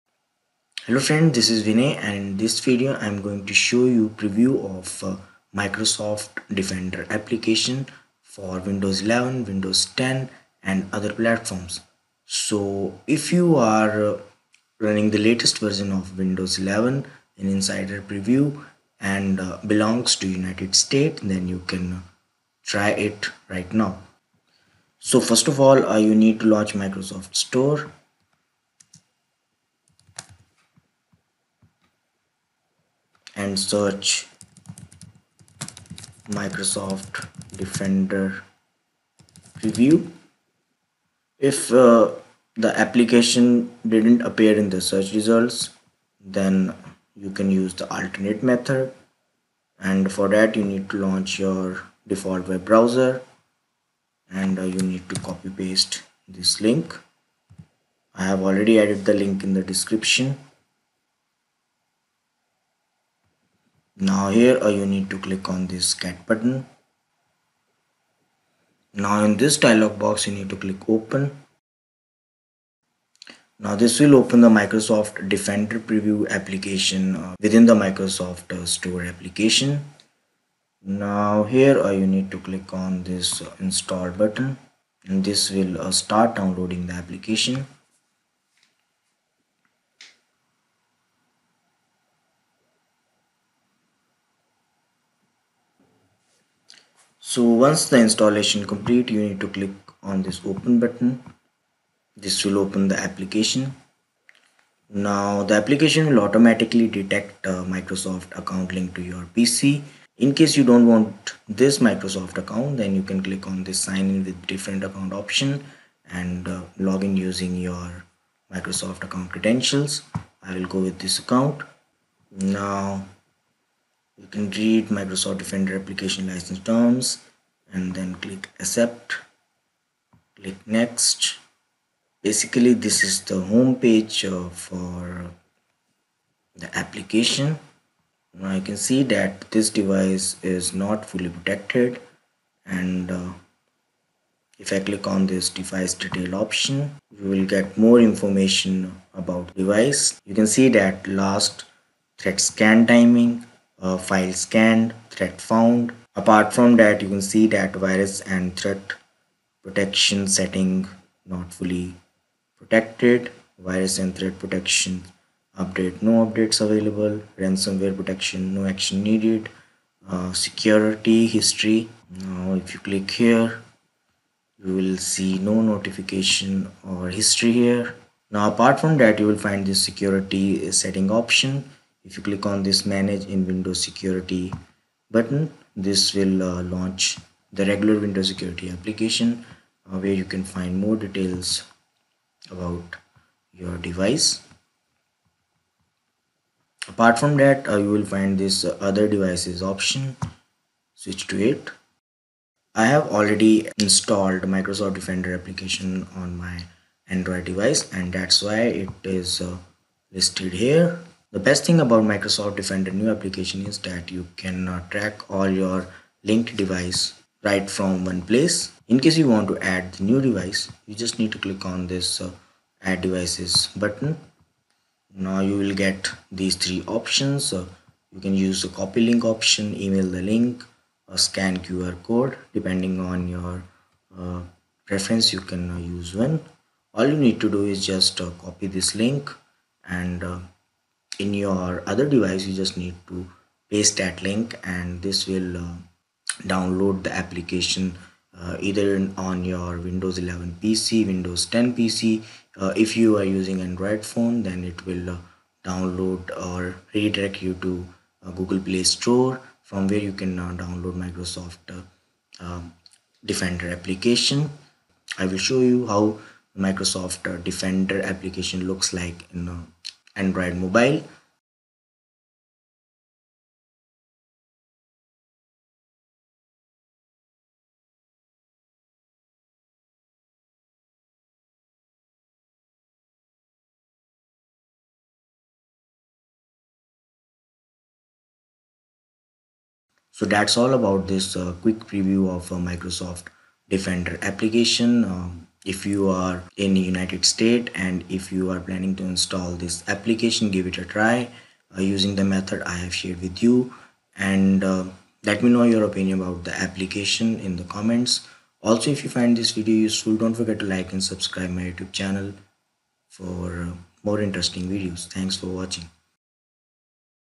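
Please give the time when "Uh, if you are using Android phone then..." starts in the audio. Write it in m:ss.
4:12.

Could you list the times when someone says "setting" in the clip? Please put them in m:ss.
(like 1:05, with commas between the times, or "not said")
2:40, 3:00.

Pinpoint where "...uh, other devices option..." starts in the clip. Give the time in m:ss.
3:18.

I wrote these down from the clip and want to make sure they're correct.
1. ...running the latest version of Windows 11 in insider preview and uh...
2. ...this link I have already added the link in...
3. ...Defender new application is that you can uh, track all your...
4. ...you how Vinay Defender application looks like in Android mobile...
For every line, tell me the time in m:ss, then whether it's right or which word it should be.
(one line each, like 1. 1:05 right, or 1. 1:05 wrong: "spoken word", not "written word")
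1. 0:14 right
2. 0:56 right
3. 3:32 right
4. 4:25 wrong: "Microsoft", not "Vinay".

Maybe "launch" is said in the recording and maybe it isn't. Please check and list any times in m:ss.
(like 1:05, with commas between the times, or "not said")
0:26, 0:51, 3:06.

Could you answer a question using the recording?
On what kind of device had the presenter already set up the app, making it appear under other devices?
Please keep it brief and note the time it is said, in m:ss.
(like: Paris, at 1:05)
Android device, at 3:27.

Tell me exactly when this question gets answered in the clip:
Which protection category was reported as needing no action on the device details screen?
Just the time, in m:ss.
2:47.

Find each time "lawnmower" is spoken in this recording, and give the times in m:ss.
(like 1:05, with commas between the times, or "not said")
not said.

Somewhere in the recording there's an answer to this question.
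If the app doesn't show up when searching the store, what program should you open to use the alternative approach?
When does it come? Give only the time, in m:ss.
0:52.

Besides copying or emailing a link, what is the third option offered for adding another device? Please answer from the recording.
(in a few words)
scan QR code.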